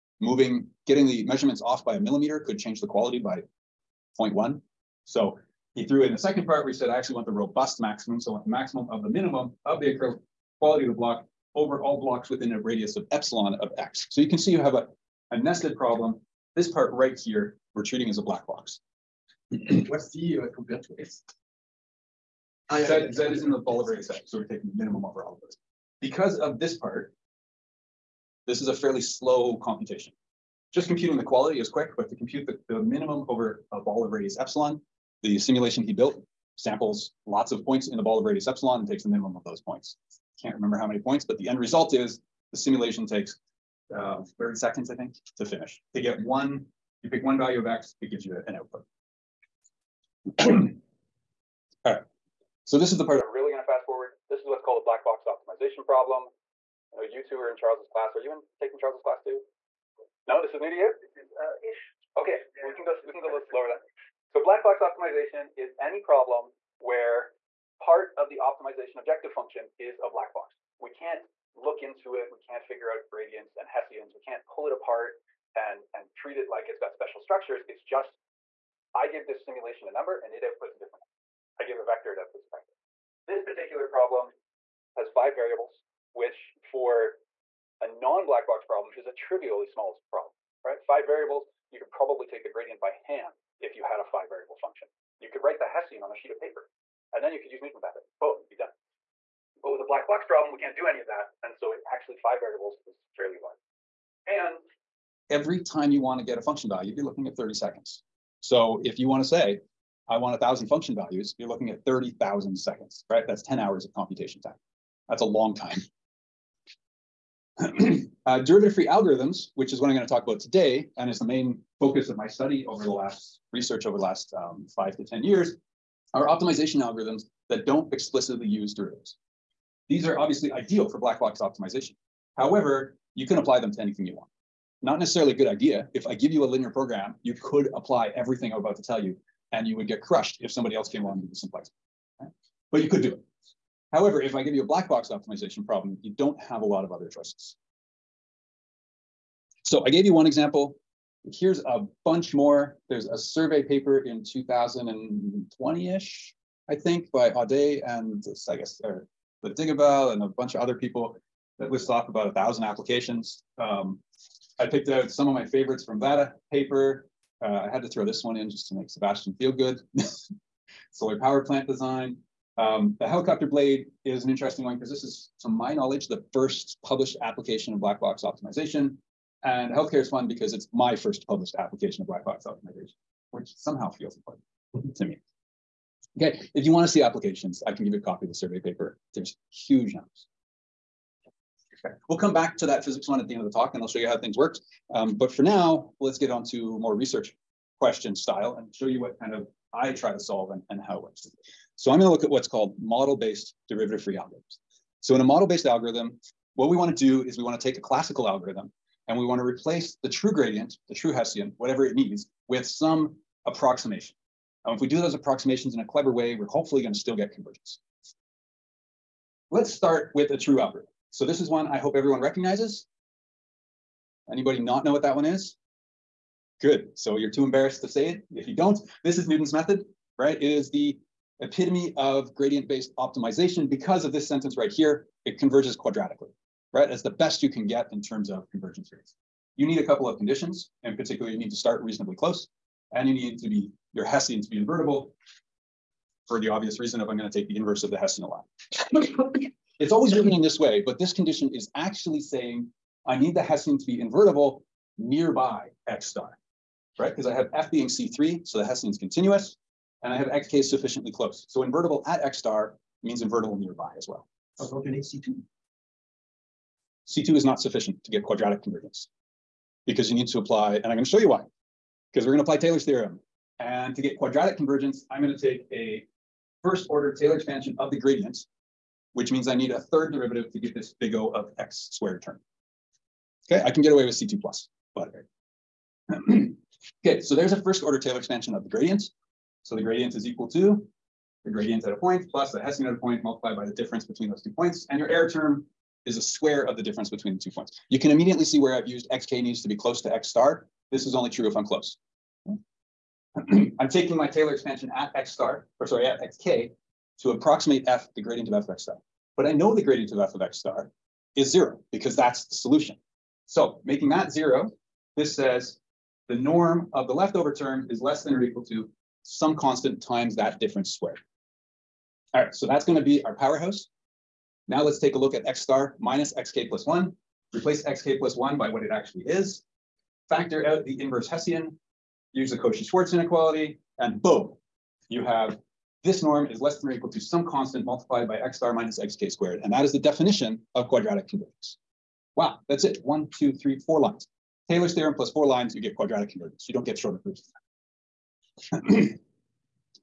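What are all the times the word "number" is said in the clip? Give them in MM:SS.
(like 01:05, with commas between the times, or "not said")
01:19, 03:09.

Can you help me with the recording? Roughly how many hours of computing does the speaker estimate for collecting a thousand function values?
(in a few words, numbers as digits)
10 hours.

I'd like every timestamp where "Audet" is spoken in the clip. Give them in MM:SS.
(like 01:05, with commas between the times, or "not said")
02:37.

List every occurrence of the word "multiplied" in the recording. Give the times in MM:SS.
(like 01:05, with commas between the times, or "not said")
04:53, 05:37.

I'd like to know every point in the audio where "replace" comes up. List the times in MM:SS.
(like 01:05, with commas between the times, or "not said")
03:29, 05:27.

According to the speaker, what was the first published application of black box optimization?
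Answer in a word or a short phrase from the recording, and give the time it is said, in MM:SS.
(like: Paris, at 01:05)
helicopter blade, at 02:52.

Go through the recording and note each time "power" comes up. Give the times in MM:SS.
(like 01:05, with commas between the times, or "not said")
02:51, 05:23.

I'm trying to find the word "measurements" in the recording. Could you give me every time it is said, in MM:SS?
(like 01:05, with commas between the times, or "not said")
00:01.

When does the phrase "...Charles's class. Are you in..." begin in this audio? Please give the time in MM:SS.
00:57.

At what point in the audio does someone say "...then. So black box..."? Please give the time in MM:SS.
01:03.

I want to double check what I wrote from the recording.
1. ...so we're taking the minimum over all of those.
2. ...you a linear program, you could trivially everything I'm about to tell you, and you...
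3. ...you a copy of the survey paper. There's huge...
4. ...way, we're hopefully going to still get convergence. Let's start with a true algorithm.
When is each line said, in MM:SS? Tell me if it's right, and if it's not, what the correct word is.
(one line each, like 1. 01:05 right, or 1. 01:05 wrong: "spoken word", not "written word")
1. 00:24 right
2. 02:16 wrong: "apply", not "trivially"
3. 03:07 right
4. 03:36 right.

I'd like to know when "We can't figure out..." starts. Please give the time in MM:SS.
01:12.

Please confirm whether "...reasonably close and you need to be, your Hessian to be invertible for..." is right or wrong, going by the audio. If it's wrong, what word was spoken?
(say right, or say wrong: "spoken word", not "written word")
right.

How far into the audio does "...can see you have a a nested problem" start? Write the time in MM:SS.
00:14.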